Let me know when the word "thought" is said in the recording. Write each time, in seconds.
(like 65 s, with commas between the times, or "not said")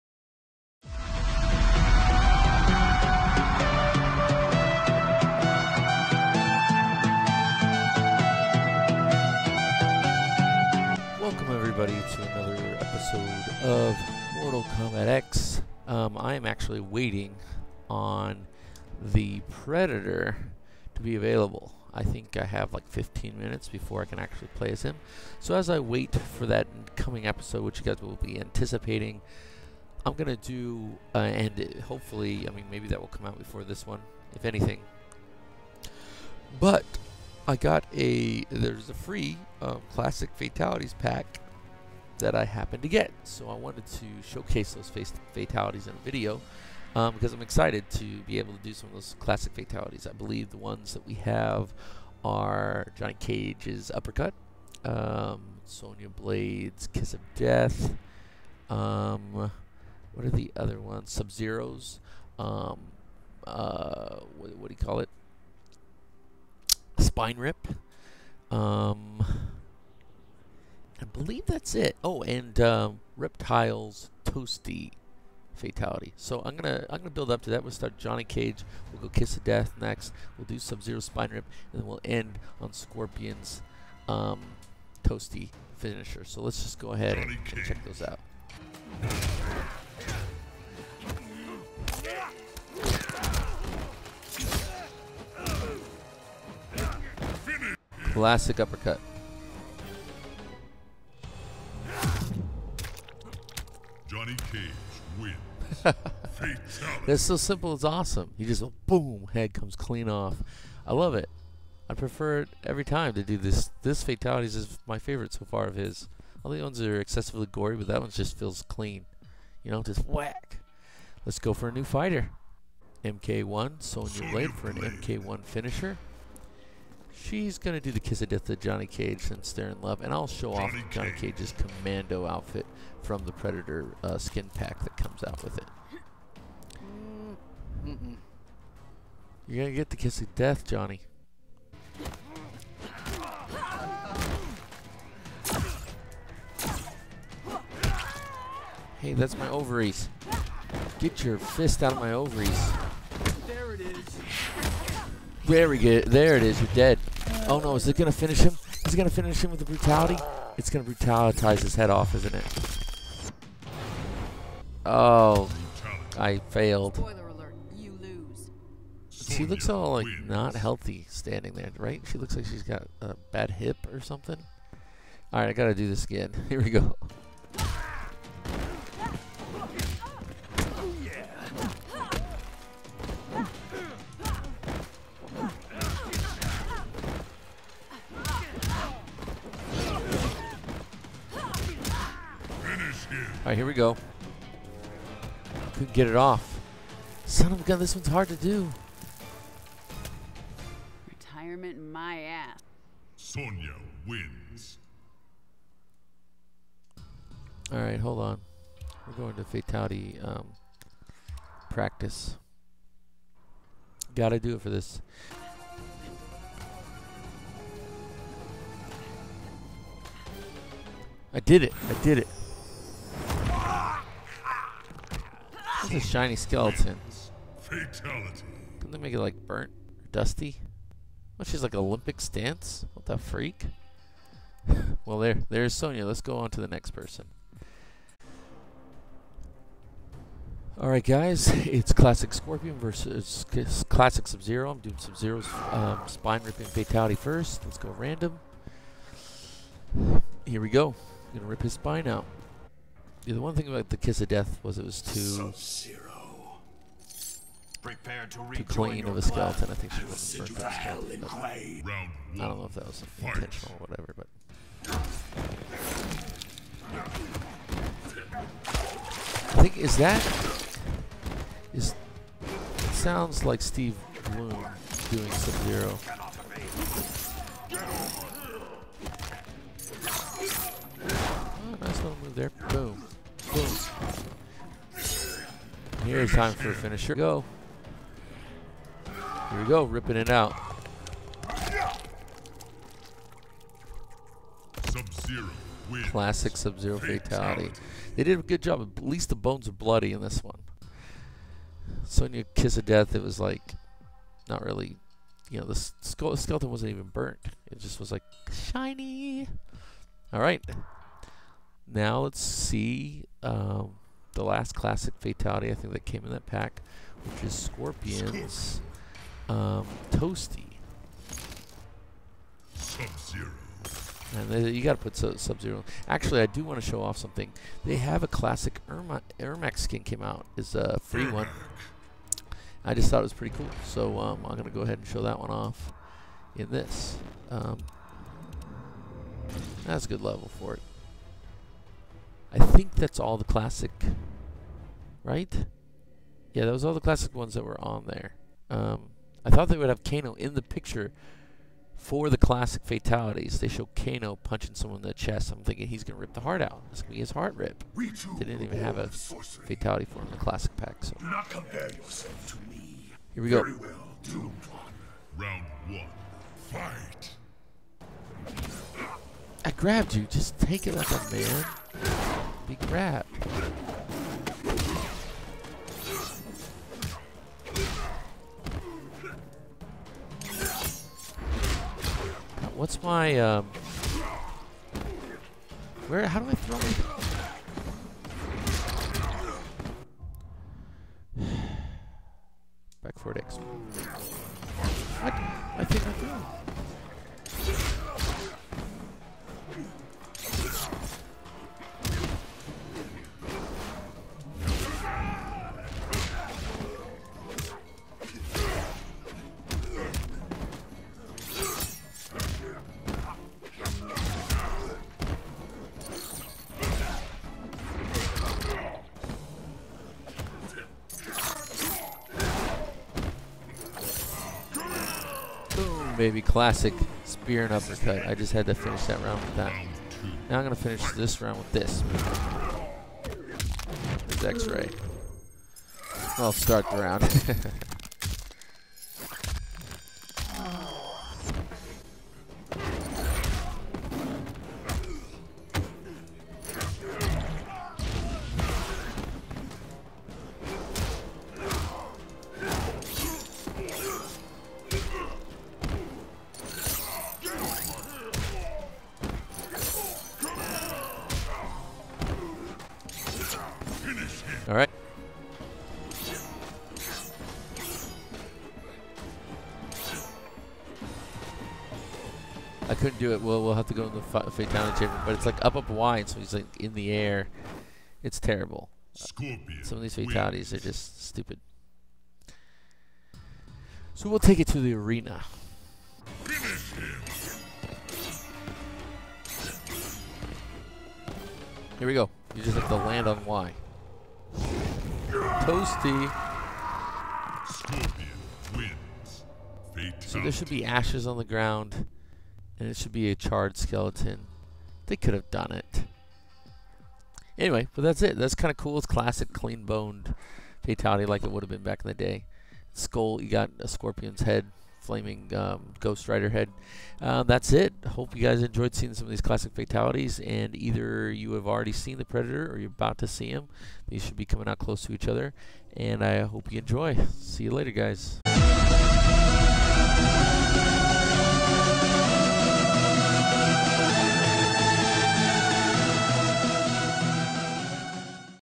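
333 s, 349 s.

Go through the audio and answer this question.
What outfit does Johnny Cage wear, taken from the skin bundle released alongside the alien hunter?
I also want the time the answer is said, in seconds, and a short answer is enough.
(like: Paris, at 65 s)
commando outfit, at 131 s.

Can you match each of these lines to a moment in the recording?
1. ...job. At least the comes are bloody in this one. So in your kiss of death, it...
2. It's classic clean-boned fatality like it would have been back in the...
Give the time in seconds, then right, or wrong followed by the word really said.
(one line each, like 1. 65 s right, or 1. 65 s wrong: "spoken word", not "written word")
1. 298 s wrong: "bones", not "comes"
2. 508 s right.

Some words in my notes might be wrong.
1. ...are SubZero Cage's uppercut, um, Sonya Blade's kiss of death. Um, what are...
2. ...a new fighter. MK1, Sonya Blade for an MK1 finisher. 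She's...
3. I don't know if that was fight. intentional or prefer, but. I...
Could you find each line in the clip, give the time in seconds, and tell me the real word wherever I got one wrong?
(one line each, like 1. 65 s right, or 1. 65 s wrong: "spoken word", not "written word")
1. 52 s wrong: "Johnny", not "SubZero"
2. 121 s right
3. 261 s wrong: "whatever", not "prefer".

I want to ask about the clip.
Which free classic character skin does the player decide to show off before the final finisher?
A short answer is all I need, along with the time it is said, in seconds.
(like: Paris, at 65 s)
Ermac, at 329 s.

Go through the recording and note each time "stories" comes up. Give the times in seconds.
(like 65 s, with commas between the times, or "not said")
not said.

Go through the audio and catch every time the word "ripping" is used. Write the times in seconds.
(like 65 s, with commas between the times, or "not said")
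246 s, 289 s.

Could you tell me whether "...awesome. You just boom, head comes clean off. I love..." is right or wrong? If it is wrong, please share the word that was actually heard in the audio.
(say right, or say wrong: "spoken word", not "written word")
right.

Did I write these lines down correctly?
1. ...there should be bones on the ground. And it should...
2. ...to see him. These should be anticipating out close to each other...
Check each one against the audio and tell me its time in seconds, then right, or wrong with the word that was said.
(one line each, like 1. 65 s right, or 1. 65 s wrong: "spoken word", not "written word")
1. 500 s wrong: "ashes", not "bones"
2. 523 s wrong: "coming", not "anticipating".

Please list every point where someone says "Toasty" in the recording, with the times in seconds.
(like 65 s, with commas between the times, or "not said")
74 s, 85 s, 320 s, 495 s.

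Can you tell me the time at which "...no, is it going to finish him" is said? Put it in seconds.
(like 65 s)
157 s.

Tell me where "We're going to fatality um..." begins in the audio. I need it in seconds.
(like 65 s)
209 s.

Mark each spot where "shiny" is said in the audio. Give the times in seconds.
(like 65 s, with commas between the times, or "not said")
225 s, 308 s.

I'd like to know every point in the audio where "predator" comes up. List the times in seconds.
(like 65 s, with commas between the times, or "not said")
19 s, 133 s, 522 s.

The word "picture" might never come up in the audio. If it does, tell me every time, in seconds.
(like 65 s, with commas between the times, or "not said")
350 s.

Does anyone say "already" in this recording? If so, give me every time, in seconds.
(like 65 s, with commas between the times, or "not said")
521 s.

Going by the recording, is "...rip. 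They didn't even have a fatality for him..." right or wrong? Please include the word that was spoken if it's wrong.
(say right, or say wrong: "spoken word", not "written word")
right.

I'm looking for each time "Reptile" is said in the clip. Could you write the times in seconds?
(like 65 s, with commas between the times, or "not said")
73 s.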